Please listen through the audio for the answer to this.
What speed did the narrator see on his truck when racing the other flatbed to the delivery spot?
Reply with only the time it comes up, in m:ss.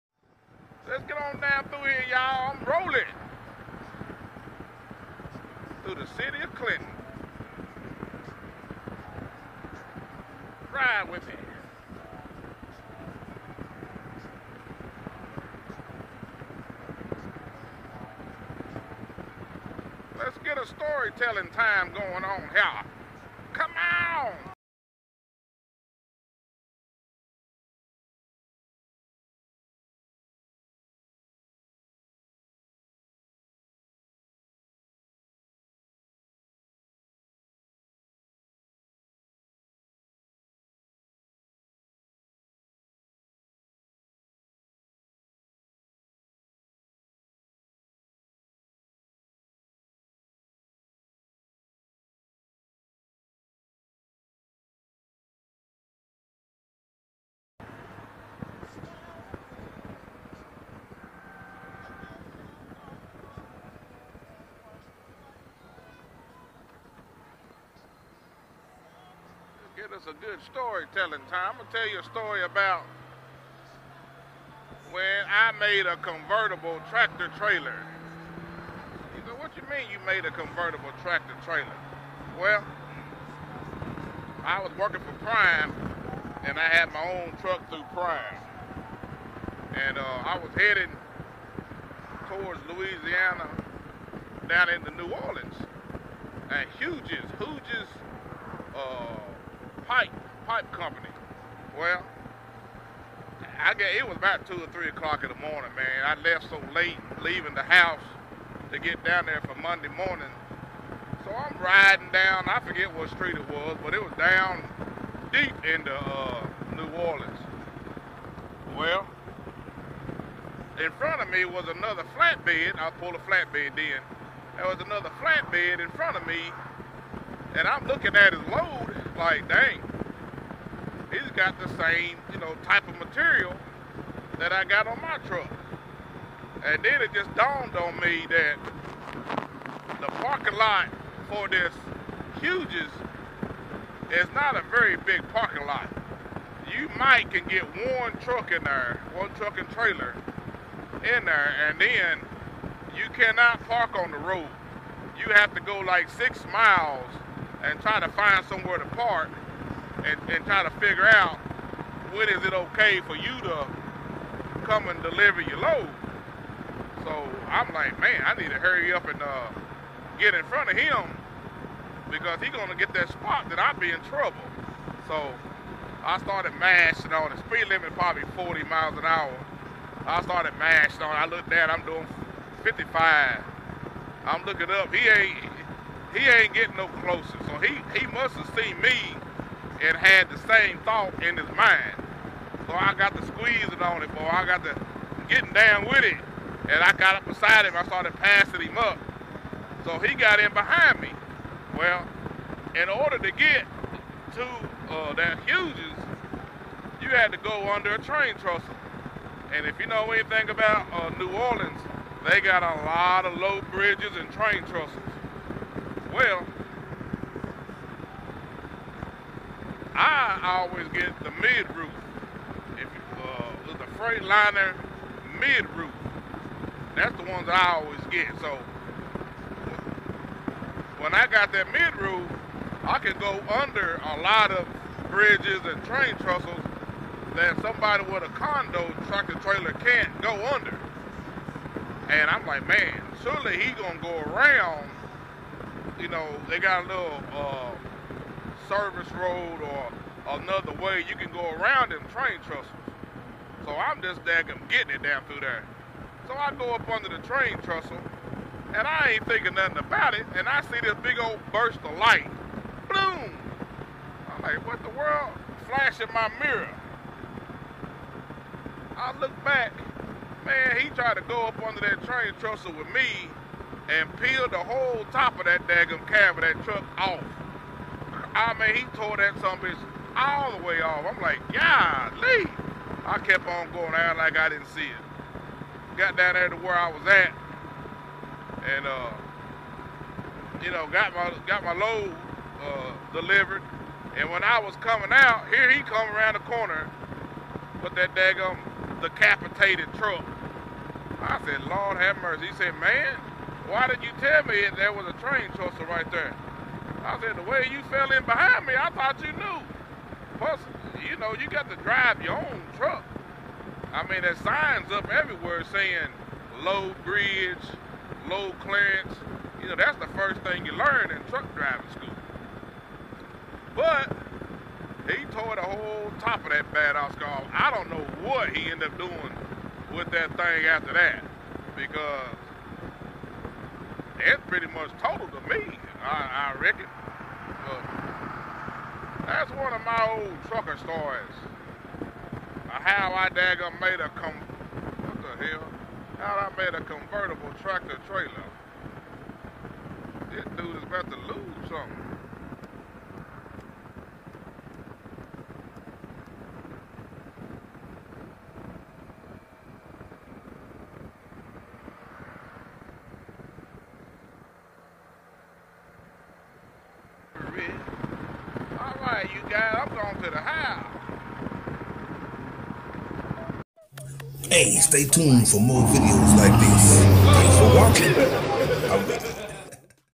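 3:02.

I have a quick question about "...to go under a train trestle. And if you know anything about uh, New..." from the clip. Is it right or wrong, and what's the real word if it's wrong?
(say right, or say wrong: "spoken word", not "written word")
right.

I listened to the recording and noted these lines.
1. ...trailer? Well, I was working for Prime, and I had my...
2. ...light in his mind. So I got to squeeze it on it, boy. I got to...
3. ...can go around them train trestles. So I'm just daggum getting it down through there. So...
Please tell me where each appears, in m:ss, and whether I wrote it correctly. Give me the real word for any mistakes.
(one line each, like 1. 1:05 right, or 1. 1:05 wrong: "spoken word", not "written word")
1. 1:21 right
2. 3:10 wrong: "thought", not "light"
3. 4:11 right.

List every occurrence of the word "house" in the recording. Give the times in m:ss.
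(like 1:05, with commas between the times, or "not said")
1:47, 6:10.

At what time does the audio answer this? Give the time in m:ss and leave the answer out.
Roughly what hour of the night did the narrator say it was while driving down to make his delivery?
1:44.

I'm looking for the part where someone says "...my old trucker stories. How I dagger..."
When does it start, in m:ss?
5:39.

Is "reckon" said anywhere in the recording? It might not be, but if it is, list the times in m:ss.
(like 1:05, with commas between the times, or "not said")
5:36.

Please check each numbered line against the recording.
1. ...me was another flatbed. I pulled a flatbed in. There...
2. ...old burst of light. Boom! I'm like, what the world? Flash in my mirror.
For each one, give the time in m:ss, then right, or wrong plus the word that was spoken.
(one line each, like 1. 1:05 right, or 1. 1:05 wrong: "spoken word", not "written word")
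1. 2:01 right
2. 4:21 right.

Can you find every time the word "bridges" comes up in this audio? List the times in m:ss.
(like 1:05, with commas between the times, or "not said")
3:33, 3:55, 5:17.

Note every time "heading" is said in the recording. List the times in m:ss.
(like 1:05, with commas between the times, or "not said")
1:30.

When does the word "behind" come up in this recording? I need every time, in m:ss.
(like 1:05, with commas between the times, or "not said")
3:20, 5:08.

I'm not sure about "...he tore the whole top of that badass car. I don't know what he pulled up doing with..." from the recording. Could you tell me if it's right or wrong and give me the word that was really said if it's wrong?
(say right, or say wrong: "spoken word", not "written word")
wrong: "ended", not "pulled".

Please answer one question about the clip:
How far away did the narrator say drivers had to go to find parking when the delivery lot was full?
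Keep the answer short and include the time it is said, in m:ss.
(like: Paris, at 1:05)
6 miles, at 2:36.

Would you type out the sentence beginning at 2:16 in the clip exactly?
And then it just dawned on me that the parking lot for this Hughes is not a very big parking lot.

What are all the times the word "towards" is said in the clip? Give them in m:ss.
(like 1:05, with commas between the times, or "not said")
1:32.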